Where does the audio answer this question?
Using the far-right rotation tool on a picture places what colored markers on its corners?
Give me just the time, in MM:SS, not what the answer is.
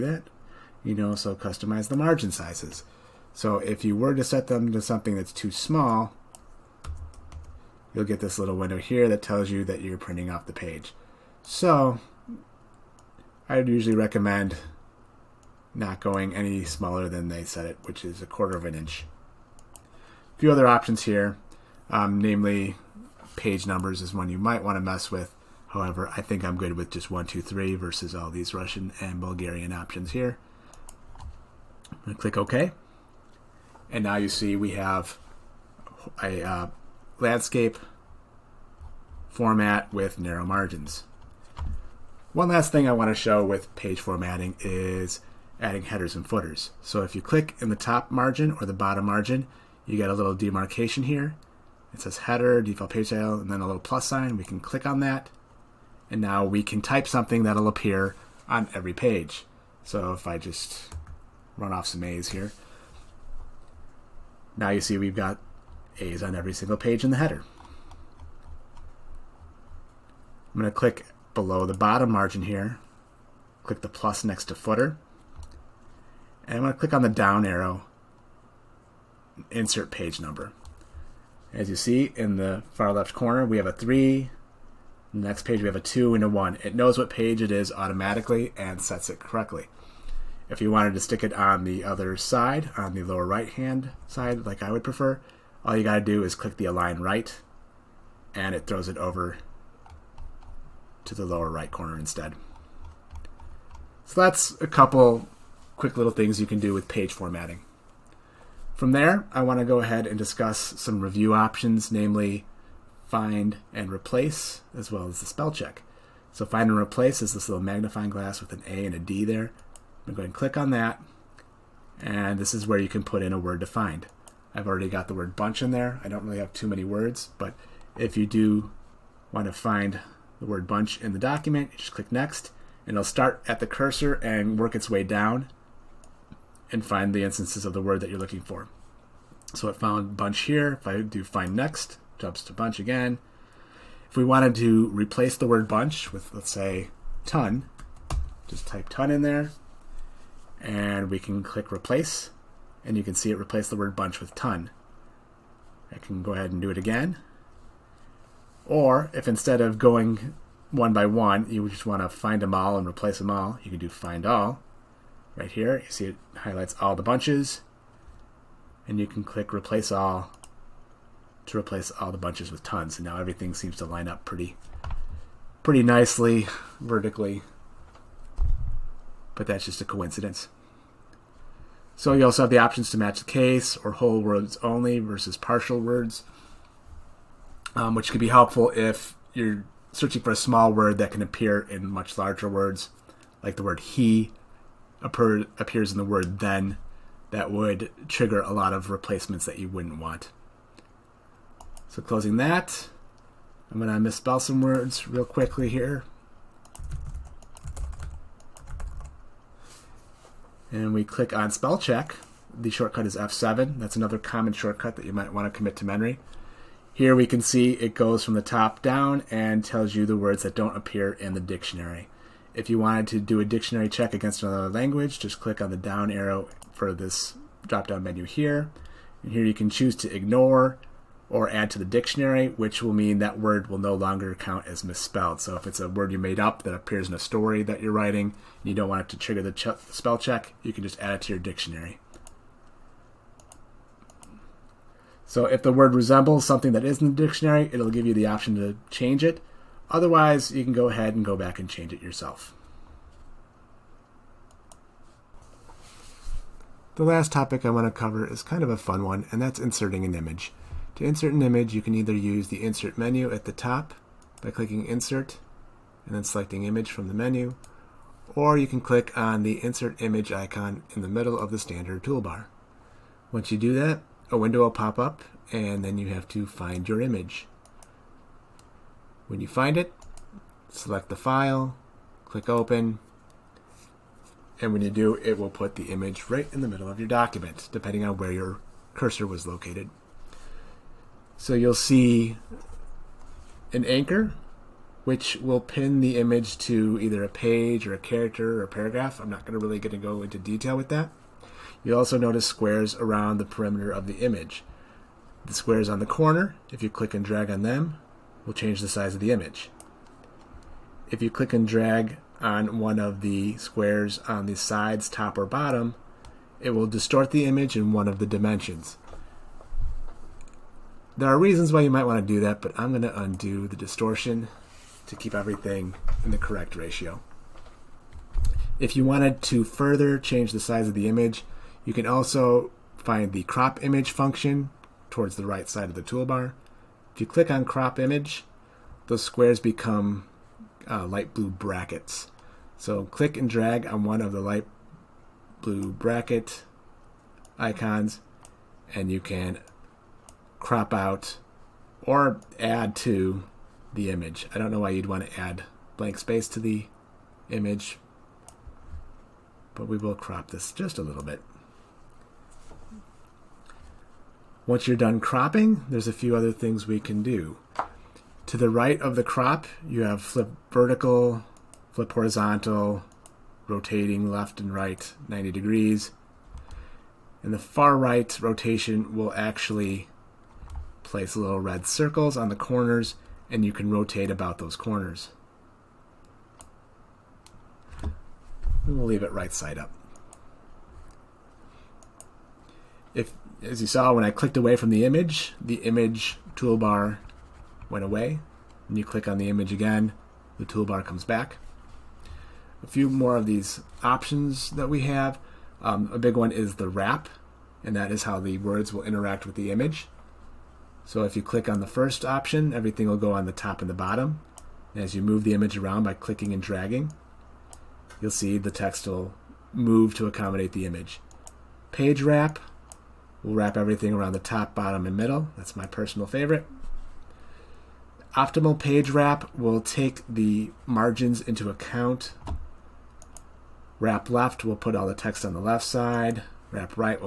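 06:21.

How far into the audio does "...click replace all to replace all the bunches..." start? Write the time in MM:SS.
02:49.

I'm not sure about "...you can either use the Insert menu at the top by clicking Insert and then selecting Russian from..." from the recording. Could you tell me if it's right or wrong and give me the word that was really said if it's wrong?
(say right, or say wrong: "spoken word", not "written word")
wrong: "Image", not "Russian".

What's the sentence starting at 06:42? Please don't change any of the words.
A few more of these options that we have.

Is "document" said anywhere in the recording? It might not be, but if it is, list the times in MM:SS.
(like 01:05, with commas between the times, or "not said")
02:11, 04:47.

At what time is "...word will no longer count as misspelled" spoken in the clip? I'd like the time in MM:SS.
03:53.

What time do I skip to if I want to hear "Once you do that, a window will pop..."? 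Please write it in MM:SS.
04:33.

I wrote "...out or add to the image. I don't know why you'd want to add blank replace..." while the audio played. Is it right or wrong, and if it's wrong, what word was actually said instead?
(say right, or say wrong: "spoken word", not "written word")
wrong: "space", not "replace".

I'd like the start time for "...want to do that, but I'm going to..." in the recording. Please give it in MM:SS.
05:22.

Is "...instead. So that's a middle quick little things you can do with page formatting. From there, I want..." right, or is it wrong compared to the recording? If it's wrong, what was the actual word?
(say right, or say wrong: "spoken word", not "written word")
wrong: "couple", not "middle".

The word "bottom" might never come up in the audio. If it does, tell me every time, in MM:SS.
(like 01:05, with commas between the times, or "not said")
00:48, 01:11, 05:15, 06:53, 07:04.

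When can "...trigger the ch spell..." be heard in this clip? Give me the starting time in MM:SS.
03:59.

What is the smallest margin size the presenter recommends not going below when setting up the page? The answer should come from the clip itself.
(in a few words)
a quarter of an inch.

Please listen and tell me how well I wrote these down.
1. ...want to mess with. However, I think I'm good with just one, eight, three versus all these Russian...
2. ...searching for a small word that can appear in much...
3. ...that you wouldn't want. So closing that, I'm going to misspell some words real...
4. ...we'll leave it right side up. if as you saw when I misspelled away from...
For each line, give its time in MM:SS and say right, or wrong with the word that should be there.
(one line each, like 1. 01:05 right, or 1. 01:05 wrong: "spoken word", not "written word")
1. 00:24 wrong: "two", not "eight"
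2. 03:09 right
3. 03:19 right
4. 06:28 wrong: "clicked", not "misspelled".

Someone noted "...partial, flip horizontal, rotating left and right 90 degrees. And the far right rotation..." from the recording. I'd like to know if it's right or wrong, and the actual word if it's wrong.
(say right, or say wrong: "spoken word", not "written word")
wrong: "vertical", not "partial".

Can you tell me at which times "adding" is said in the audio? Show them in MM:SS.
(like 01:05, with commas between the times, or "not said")
00:45.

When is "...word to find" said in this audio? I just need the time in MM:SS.
02:03.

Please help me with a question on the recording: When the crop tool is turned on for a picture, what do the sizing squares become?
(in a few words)
light blue brackets.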